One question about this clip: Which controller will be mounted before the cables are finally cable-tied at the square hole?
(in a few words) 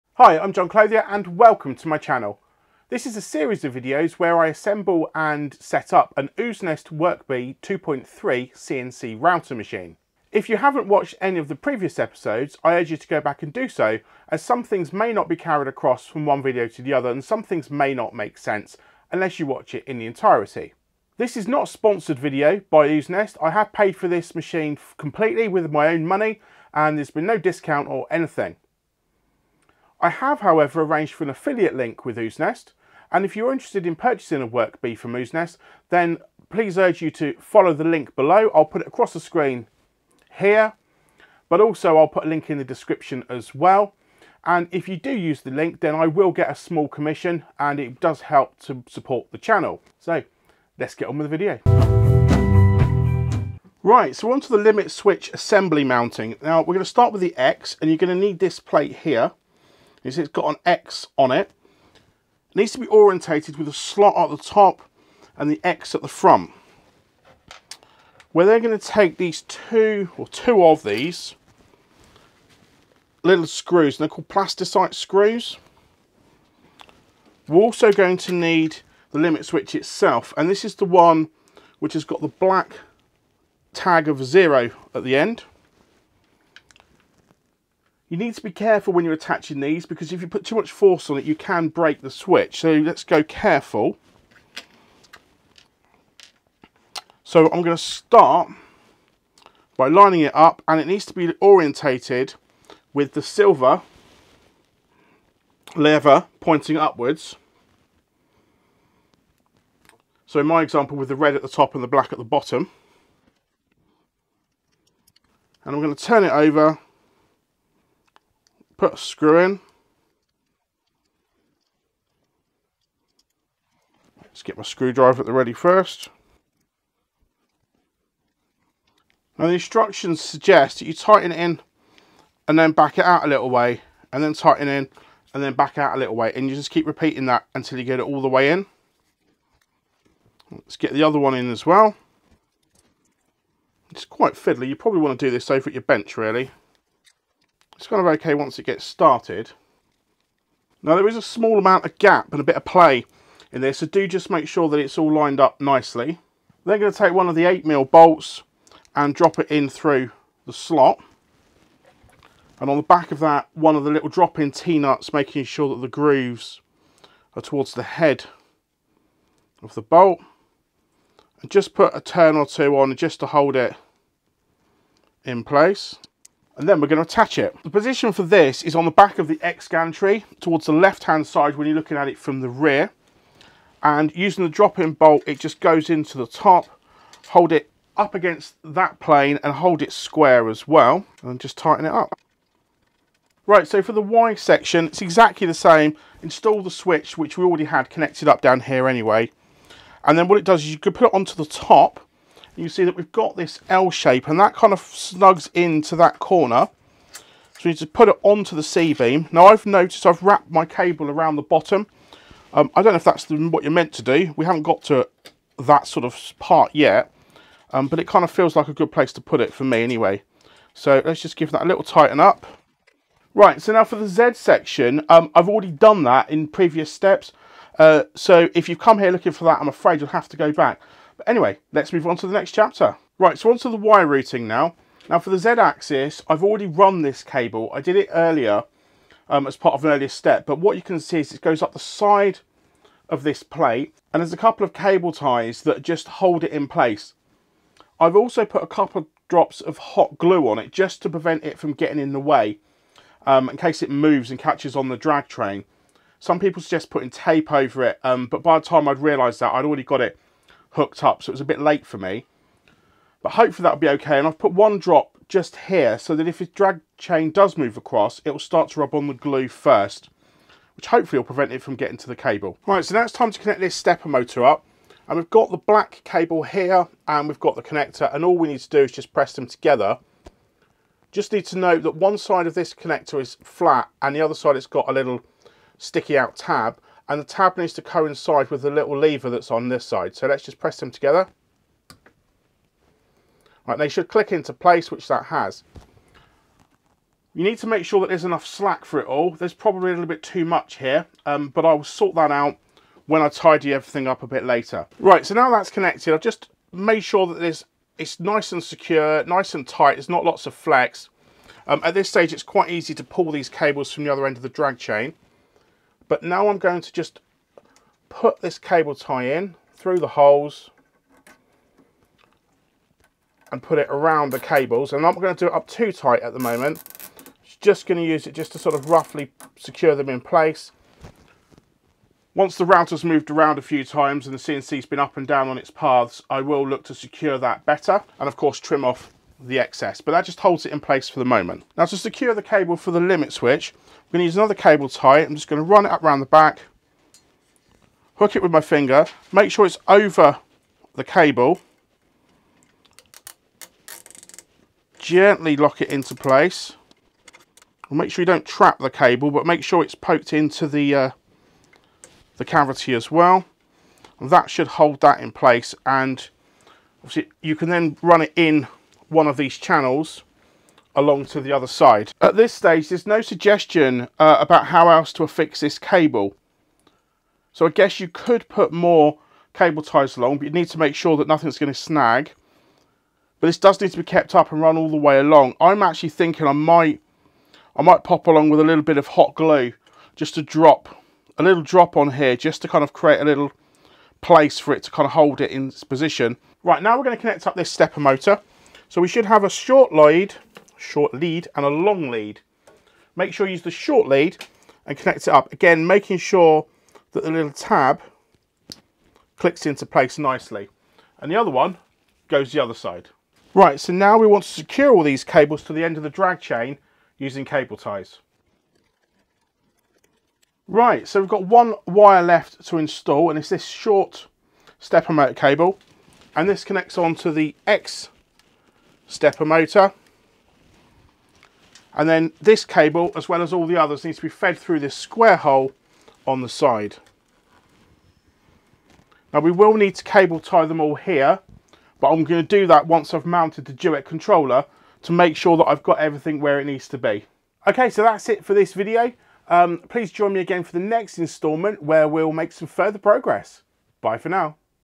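Duet controller.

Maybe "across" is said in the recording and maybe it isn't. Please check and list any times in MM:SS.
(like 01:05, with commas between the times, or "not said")
00:15, 00:38, 04:27.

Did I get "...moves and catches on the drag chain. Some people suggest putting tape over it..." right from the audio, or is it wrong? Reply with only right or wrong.
right.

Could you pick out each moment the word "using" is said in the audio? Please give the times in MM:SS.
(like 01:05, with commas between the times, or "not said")
03:04, 06:57.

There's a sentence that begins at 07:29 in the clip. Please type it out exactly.
Um, please join me again for the next instalment where we'll make some further progress.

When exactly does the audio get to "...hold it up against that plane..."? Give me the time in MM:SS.
03:07.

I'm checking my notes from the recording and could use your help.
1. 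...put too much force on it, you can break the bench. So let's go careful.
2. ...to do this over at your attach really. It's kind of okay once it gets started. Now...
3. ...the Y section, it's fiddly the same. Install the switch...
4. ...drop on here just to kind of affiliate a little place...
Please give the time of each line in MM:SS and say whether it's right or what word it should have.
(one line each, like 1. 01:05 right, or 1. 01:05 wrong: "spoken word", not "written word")
1. 01:30 wrong: "switch", not "bench"
2. 02:25 wrong: "bench", not "attach"
3. 03:13 wrong: "exactly", not "fiddly"
4. 06:31 wrong: "create", not "affiliate".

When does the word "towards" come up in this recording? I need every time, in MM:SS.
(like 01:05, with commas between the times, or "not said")
02:47, 03:00.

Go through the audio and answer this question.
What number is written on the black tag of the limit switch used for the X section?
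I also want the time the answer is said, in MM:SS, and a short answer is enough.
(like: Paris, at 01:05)
0, at 01:24.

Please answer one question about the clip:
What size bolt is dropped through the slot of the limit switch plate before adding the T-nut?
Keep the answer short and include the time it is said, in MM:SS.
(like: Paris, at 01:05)
8 mil, at 02:37.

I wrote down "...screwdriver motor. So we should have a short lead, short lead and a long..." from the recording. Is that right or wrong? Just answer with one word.
wrong.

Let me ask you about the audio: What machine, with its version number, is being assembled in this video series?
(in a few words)
WorkBee 2.3.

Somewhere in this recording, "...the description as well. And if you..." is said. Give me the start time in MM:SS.
00:42.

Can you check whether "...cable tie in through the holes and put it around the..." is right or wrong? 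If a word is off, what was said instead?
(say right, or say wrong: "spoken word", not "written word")
right.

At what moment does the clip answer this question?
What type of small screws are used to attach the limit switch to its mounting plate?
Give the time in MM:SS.
01:14.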